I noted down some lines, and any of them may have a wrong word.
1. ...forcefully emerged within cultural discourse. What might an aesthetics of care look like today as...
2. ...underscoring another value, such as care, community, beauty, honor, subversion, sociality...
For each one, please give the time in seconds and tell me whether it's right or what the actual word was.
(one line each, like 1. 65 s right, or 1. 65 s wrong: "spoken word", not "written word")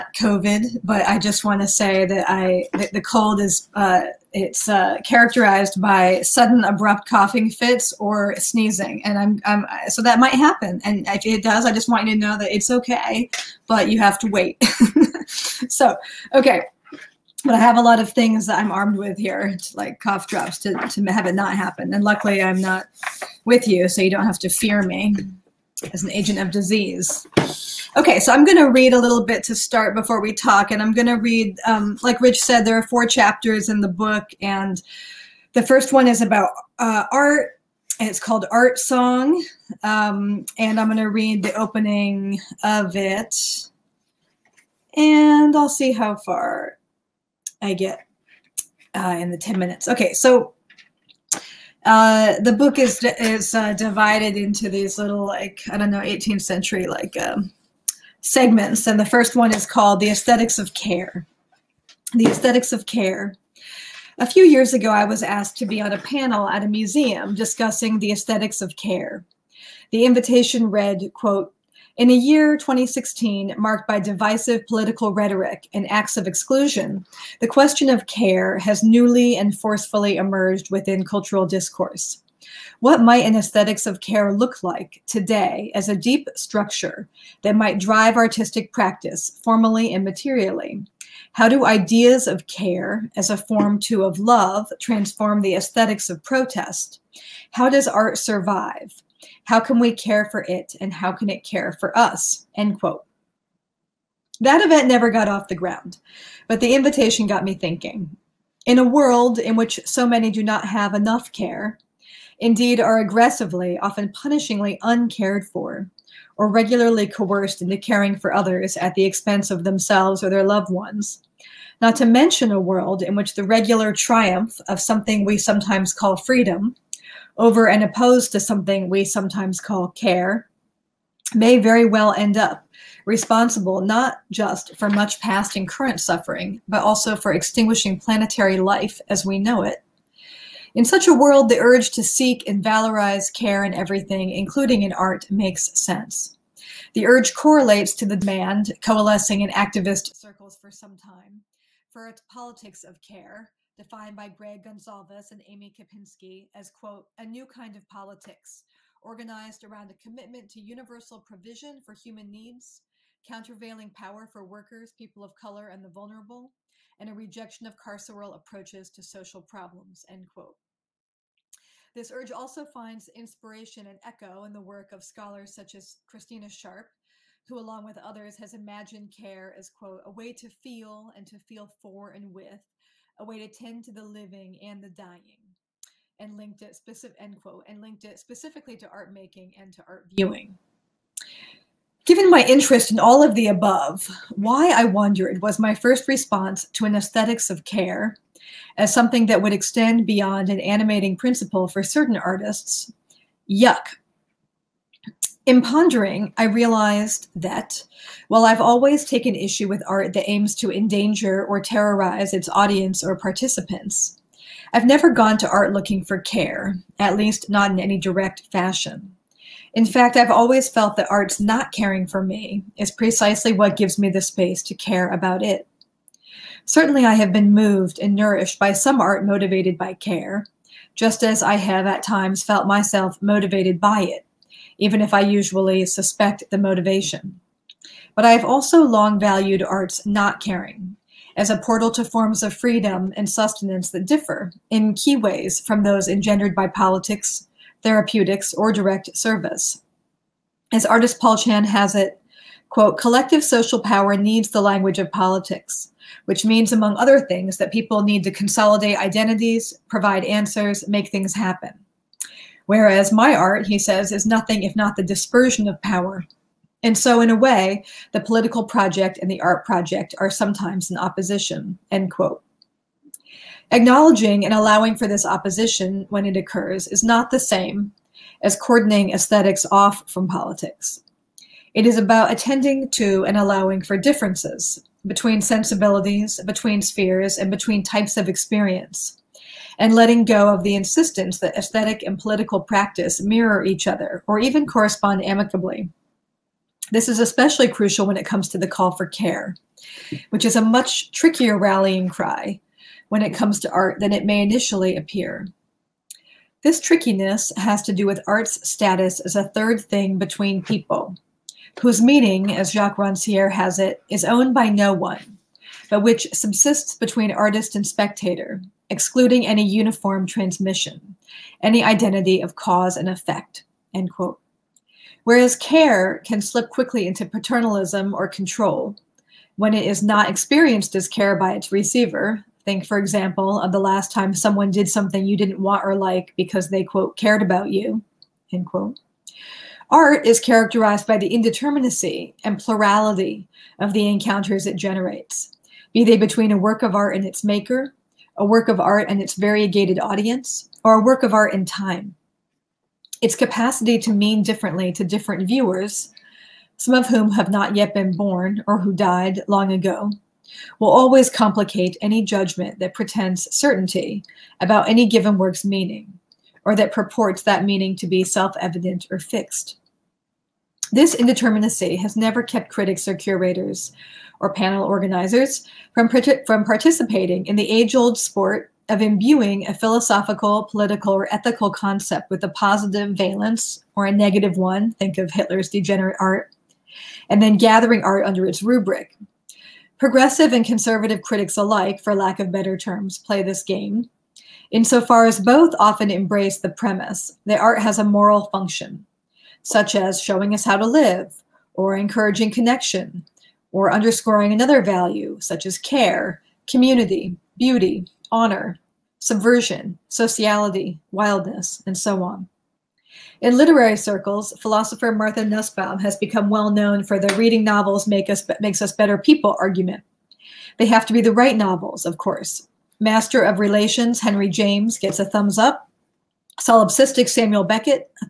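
1. 79 s right
2. 403 s right.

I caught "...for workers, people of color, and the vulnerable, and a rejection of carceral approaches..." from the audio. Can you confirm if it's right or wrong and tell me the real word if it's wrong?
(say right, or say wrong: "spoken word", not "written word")
right.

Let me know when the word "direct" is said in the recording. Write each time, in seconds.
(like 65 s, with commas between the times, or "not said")
217 s, 248 s.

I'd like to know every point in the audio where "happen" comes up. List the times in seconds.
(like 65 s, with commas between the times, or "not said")
10 s, 21 s, 261 s.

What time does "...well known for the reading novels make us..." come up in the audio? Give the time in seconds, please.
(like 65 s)
416 s.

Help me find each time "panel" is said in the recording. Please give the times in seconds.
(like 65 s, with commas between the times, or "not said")
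65 s, 374 s.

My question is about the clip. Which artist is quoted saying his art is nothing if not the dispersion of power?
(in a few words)
Paul Chan.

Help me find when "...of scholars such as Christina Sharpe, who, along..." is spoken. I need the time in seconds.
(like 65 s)
174 s.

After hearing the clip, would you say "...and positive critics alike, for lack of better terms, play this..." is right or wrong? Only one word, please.
wrong.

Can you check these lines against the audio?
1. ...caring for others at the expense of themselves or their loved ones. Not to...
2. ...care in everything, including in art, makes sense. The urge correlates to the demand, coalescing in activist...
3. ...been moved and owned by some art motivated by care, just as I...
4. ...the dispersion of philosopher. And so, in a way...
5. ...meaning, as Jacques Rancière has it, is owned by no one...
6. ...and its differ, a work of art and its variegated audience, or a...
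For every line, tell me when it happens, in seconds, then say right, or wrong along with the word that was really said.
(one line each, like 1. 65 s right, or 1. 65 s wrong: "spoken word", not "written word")
1. 117 s right
2. 143 s right
3. 227 s wrong: "nourished", not "owned"
4. 264 s wrong: "power", not "philosopher"
5. 312 s right
6. 347 s wrong: "maker", not "differ".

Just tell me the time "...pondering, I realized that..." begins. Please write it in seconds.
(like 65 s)
205 s.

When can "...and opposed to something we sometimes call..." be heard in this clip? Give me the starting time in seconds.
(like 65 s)
127 s.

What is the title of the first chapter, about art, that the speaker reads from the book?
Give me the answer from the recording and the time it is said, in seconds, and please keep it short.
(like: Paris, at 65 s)
Art Song, at 38 s.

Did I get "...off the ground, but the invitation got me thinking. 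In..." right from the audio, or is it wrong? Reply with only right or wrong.
right.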